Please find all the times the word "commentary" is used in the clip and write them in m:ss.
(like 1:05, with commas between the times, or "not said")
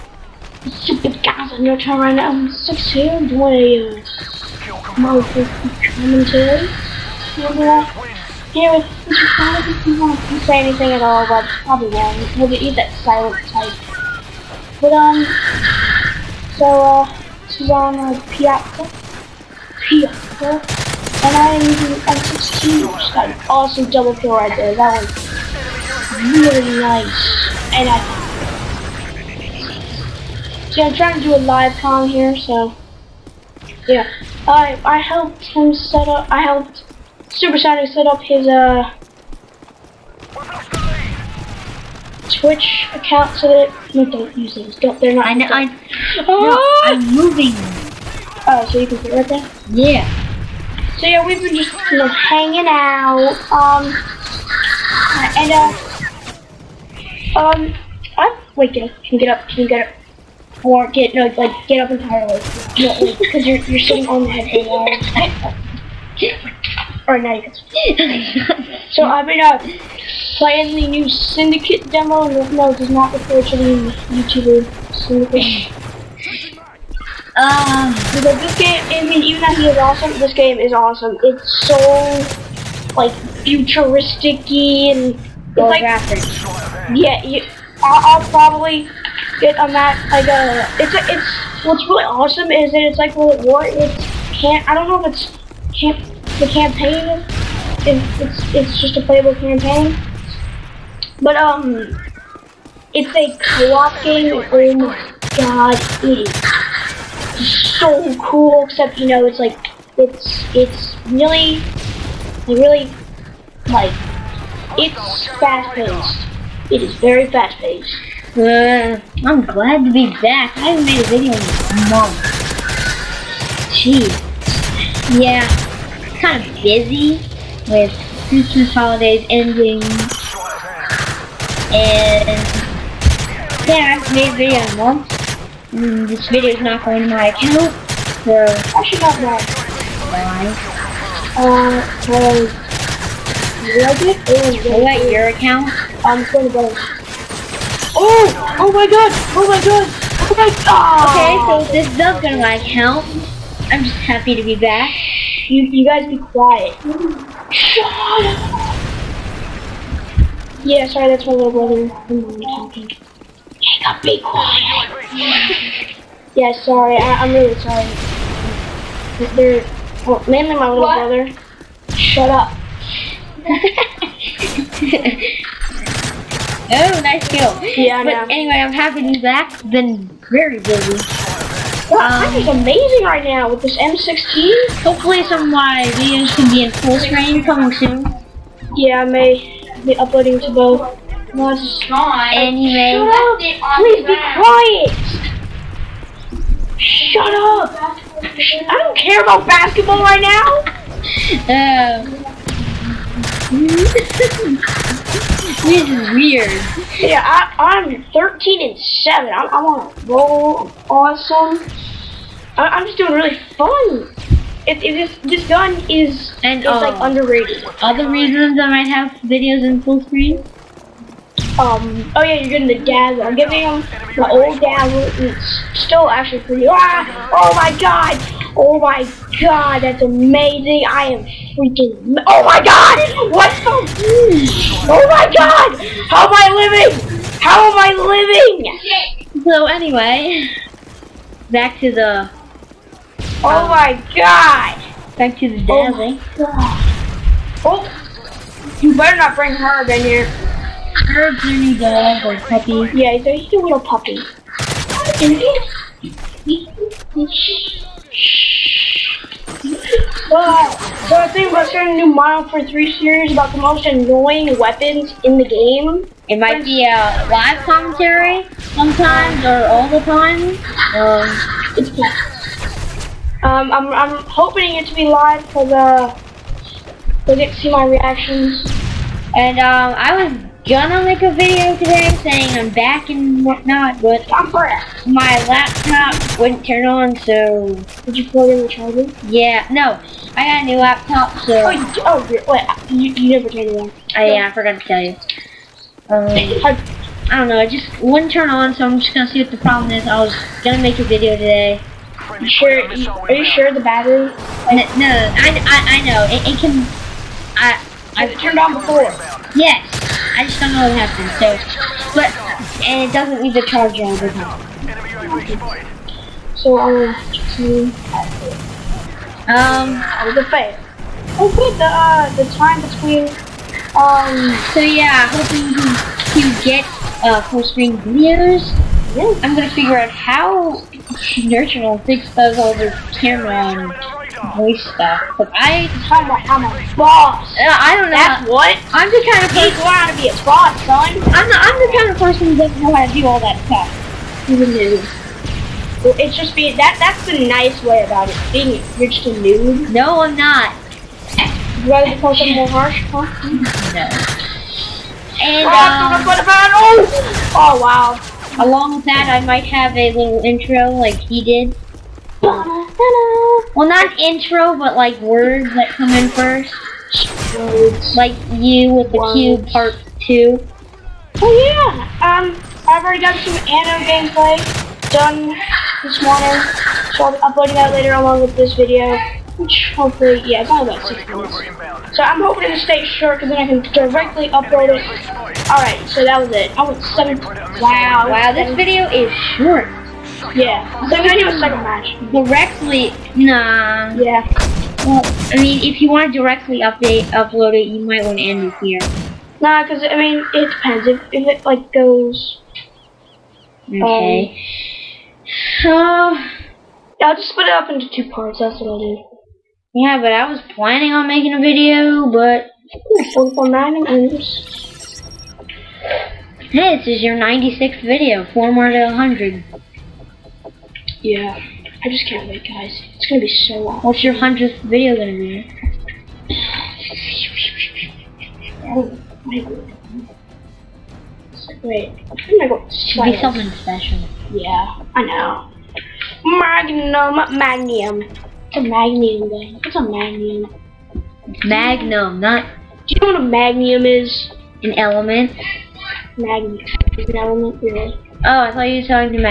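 0:04, 4:27.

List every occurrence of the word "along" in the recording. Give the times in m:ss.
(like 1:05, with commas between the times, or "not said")
5:58, 6:18.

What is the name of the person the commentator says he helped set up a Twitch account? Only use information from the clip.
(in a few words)
Supersonic.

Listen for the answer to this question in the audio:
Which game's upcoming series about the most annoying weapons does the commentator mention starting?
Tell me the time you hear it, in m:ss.
4:22.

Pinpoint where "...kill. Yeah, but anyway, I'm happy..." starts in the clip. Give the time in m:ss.
2:57.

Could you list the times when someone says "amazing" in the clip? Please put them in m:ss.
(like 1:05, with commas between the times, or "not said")
3:02, 3:50.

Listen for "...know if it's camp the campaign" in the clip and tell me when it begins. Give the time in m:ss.
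1:34.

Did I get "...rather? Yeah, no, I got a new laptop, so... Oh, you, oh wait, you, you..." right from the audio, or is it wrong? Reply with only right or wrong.
wrong.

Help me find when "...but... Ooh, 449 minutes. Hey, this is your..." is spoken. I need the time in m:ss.
6:52.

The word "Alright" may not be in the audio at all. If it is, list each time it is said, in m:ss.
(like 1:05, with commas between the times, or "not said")
6:25.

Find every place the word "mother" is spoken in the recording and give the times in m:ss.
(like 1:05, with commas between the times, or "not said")
not said.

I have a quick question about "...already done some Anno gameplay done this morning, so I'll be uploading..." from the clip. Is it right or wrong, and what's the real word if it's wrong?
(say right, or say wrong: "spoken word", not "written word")
right.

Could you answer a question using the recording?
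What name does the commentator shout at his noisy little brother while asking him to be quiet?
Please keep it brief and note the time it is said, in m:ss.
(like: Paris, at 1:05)
Jacob, at 2:42.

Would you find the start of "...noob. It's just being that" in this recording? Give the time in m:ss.
5:44.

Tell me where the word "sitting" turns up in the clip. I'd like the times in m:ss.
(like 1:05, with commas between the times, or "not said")
1:03.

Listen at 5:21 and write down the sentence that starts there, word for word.
Oh good the uh the time between um so yeah hoping to you get uh full screen videos.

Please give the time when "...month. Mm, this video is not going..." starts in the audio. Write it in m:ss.
2:14.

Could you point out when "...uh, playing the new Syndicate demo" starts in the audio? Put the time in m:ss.
1:09.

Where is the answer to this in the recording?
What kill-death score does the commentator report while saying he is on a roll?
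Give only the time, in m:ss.
3:28.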